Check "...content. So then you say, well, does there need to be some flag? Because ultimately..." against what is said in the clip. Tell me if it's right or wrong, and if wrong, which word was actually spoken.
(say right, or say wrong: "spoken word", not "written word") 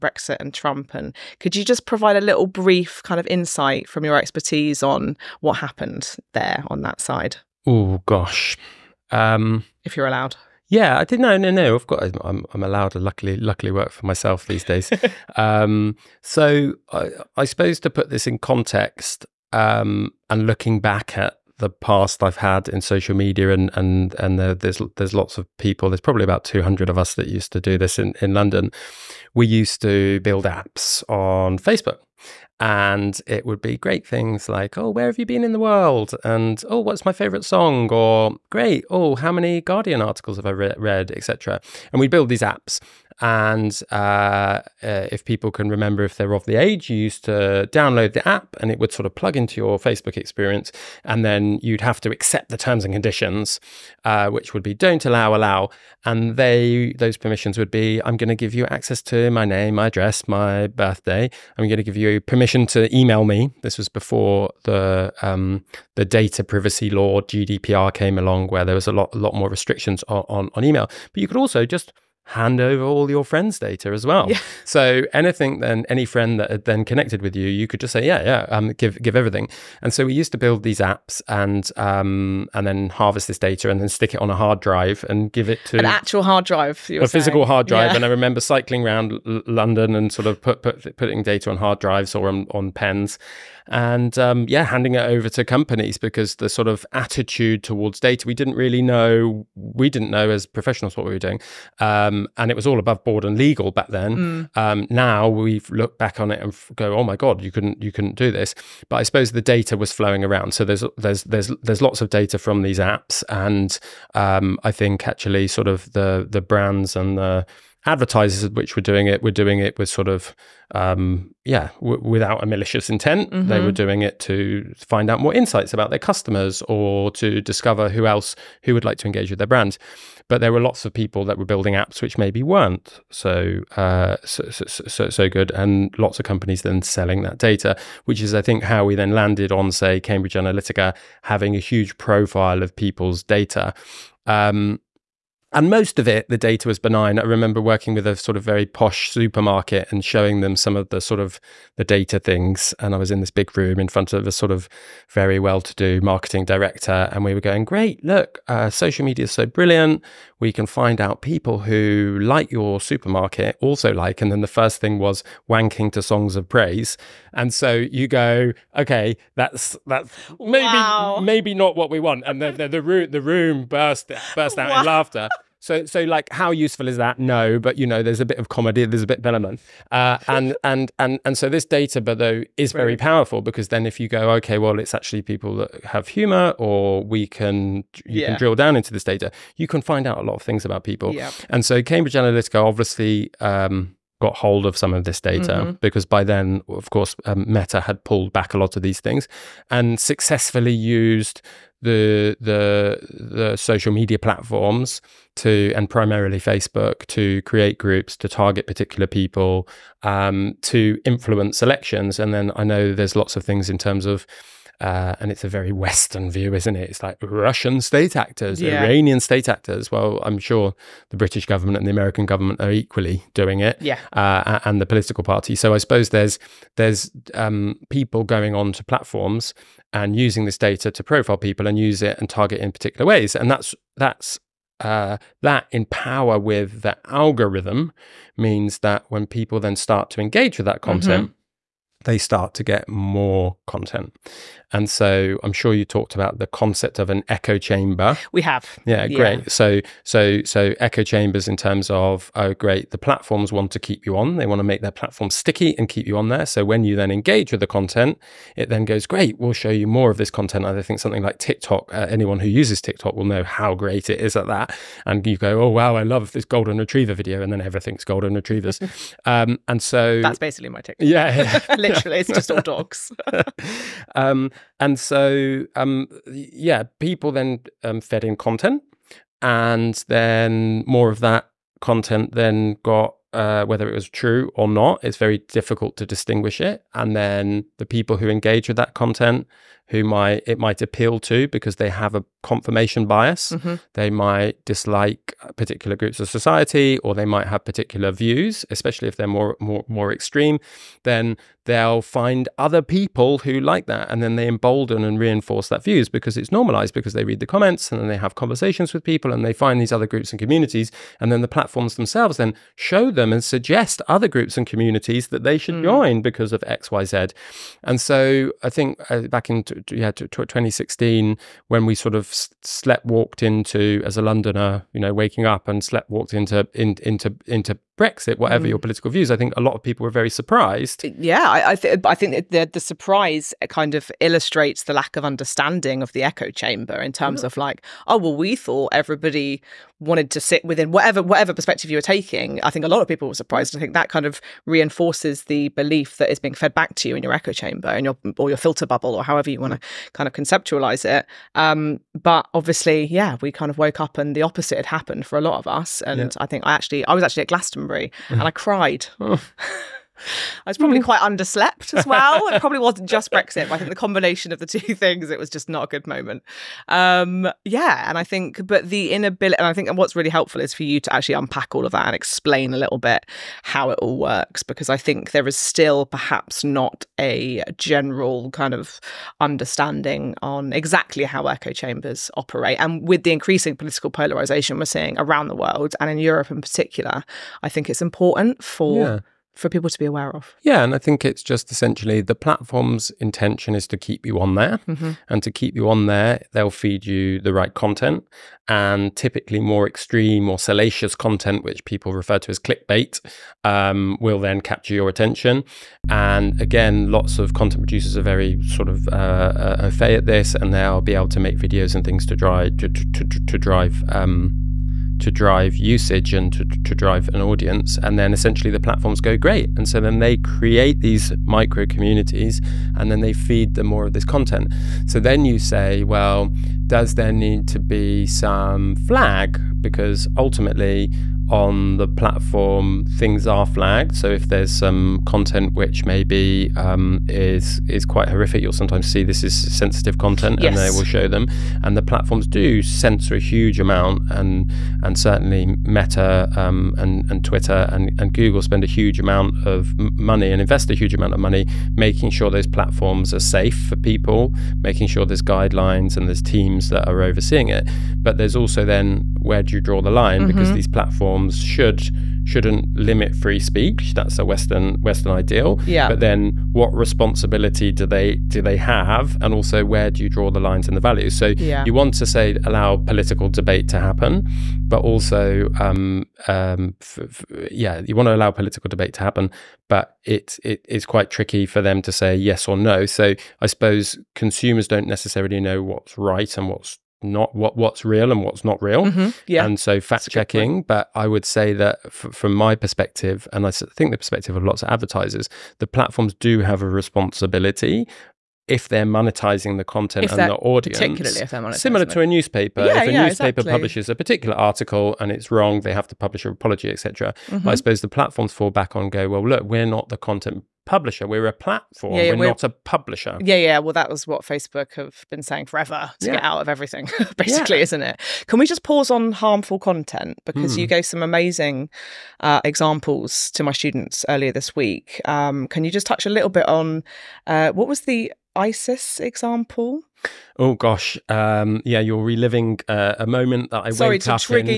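right.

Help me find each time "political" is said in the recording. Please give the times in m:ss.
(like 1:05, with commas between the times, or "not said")
3:44, 5:28, 6:23, 7:52, 7:58.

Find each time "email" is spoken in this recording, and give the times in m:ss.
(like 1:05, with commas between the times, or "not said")
1:02, 1:10.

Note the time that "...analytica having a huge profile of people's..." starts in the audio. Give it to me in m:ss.
2:20.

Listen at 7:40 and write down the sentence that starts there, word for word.
because these platforms platforms should shouldn't limit free speech.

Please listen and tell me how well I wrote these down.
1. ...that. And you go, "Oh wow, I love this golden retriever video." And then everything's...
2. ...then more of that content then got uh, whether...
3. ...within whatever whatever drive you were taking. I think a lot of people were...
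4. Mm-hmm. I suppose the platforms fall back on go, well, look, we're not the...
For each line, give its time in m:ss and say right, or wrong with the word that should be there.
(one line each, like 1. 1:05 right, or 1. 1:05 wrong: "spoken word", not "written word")
1. 4:24 right
2. 4:40 right
3. 5:40 wrong: "perspective", not "drive"
4. 8:27 right.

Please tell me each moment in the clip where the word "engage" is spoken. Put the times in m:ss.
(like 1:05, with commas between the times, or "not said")
2:09, 4:00, 4:17, 4:48.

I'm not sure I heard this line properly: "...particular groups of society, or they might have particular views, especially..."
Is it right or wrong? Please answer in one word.
right.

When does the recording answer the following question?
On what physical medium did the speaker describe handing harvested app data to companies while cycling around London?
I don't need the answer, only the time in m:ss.
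1:31.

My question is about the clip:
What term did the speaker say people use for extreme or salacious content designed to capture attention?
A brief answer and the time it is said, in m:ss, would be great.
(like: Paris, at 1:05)
clickbait, at 6:42.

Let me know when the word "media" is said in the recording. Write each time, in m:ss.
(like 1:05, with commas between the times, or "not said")
0:23, 2:39, 3:23.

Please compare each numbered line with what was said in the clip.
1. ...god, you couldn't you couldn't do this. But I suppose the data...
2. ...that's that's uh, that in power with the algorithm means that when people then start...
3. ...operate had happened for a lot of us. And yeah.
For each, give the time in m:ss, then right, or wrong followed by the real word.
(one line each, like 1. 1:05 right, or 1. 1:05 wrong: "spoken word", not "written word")
1. 1:47 right
2. 3:53 right
3. 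5:54 wrong: "opposite", not "operate".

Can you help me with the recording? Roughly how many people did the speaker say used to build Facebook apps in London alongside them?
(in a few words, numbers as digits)
200.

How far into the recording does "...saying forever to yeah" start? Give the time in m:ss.
8:35.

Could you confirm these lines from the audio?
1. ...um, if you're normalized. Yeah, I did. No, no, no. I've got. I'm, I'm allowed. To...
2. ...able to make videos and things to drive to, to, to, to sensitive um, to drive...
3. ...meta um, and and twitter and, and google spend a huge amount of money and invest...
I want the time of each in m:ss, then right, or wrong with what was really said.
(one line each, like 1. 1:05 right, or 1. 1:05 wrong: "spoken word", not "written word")
1. 0:09 wrong: "allowed", not "normalized"
2. 6:51 wrong: "drive", not "sensitive"
3. 7:25 right.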